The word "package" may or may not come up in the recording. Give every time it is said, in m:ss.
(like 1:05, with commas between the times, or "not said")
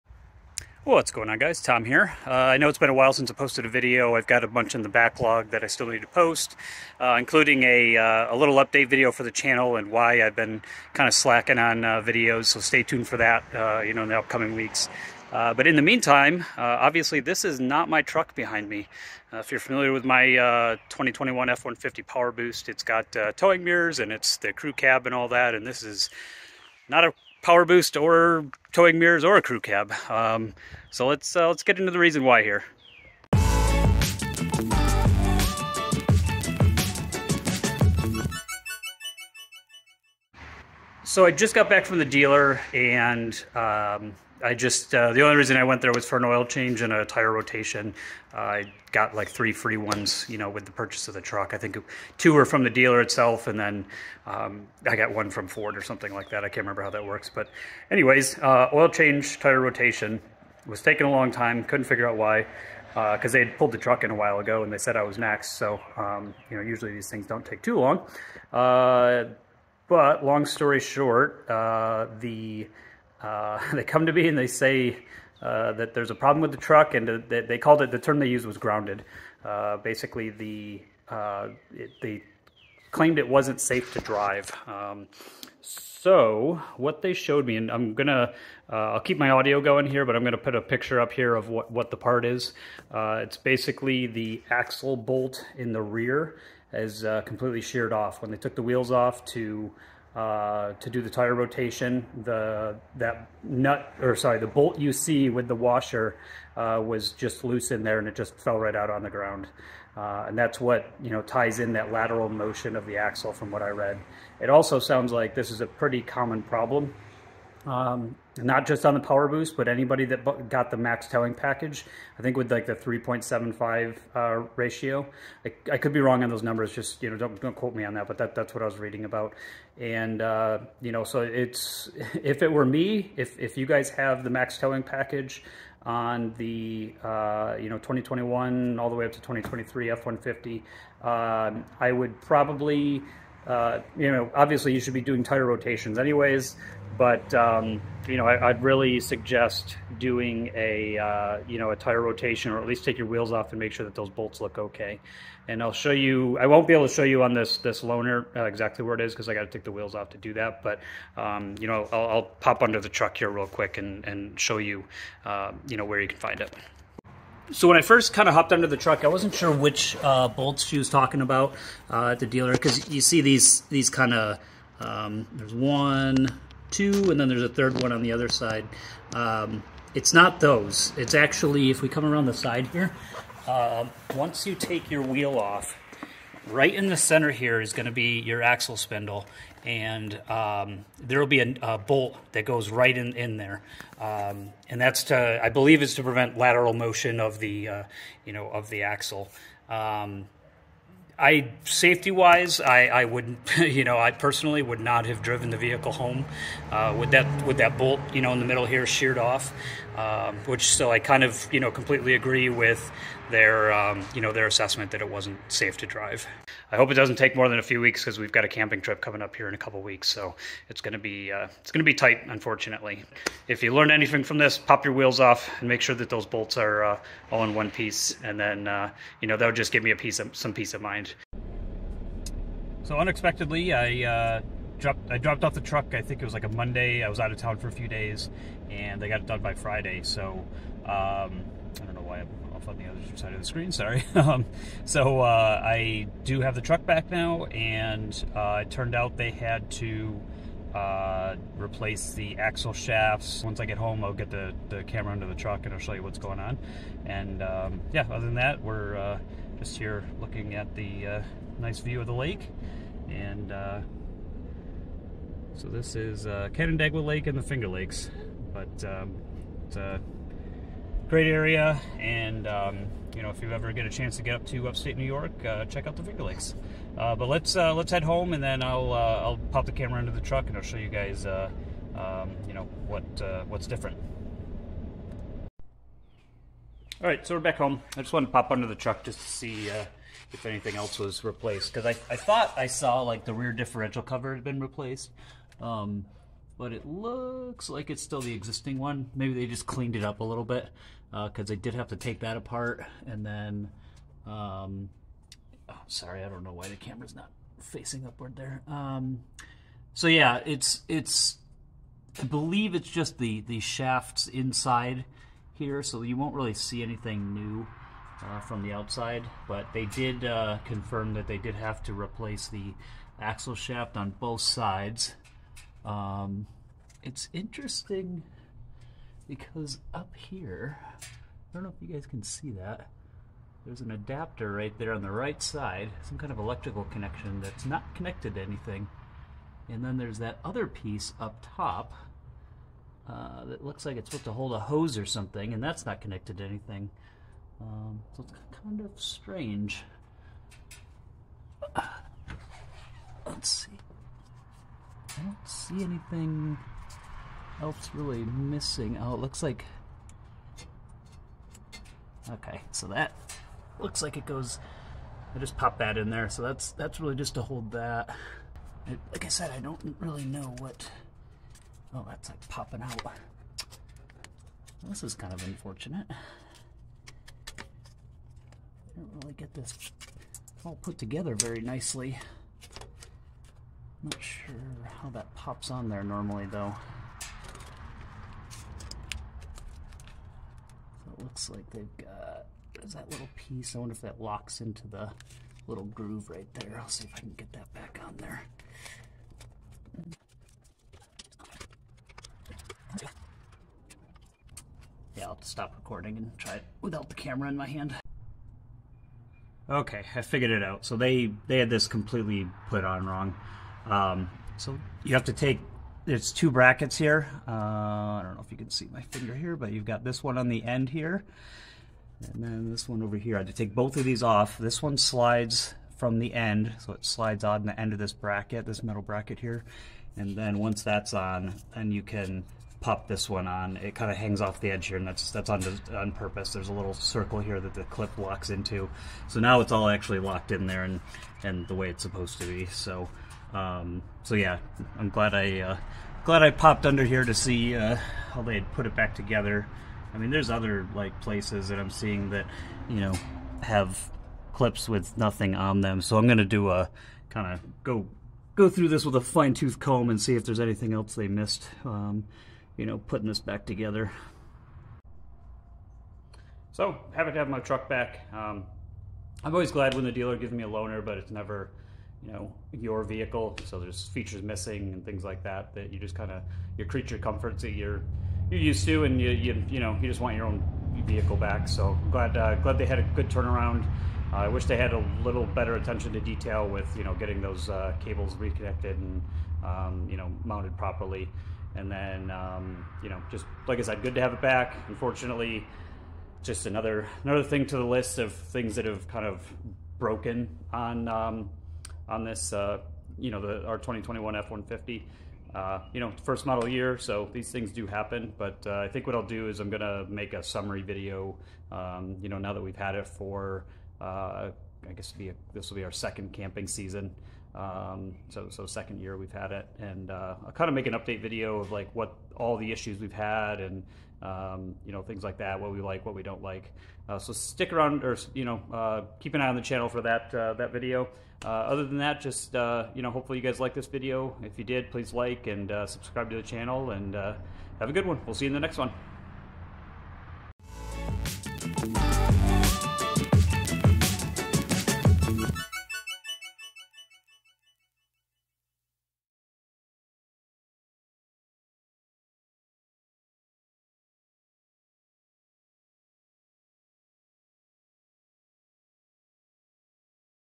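2:01, 2:14.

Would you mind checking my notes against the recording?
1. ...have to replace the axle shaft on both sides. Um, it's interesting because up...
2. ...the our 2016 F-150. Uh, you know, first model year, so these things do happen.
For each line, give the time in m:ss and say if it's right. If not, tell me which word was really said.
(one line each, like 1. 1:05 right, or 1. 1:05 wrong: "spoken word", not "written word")
1. 5:21 right
2. 8:23 wrong: "2021", not "2016".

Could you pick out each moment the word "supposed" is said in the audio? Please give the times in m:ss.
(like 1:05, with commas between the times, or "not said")
5:44, 7:22.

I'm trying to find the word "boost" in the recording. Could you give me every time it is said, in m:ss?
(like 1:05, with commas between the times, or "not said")
0:22, 0:27, 1:59.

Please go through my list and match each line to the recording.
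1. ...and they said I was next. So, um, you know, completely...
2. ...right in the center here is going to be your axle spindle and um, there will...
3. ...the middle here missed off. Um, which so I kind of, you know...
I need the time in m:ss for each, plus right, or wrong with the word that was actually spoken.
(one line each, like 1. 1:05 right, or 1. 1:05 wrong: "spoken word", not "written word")
1. 1:04 wrong: "usually", not "completely"
2. 3:06 right
3. 3:28 wrong: "sheared", not "missed".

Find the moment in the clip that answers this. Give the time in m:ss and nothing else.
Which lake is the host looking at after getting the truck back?
4:26.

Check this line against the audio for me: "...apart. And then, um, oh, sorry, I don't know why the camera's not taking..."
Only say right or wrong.
wrong.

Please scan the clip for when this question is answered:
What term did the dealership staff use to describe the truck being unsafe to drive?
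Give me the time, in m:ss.
1:18.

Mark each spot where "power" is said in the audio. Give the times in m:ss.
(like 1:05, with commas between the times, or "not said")
0:22, 0:27, 1:58.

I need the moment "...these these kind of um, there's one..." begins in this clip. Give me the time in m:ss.
2:53.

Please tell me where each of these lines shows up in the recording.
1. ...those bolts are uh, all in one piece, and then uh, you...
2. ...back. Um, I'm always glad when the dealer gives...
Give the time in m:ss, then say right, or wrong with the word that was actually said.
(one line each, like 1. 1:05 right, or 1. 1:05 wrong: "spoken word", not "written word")
1. 3:46 right
2. 7:47 right.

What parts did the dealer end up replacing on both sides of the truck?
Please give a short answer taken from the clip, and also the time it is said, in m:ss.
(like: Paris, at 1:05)
Axle shafts, at 4:12.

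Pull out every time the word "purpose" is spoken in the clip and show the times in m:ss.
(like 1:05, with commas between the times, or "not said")
7:16.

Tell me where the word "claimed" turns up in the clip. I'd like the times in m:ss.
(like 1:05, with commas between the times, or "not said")
1:22.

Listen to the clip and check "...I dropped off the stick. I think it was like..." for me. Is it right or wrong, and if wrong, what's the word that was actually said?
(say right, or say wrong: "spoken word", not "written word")
wrong: "truck", not "stick".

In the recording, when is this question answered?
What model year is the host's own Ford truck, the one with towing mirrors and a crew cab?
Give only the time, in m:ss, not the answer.
0:20.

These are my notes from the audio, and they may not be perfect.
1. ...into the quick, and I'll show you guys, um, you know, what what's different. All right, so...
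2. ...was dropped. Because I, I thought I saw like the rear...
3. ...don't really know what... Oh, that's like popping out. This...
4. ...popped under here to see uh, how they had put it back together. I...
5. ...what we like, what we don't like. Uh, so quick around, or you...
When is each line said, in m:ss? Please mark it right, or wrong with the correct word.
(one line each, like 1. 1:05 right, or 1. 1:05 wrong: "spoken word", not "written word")
1. 4:40 wrong: "truck", not "quick"
2. 4:50 wrong: "replaced", not "dropped"
3. 6:09 right
4. 7:26 right
5. 8:45 wrong: "stick", not "quick".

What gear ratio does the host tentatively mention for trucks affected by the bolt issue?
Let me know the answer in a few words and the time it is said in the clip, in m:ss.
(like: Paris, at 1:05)
3.75, at 2:02.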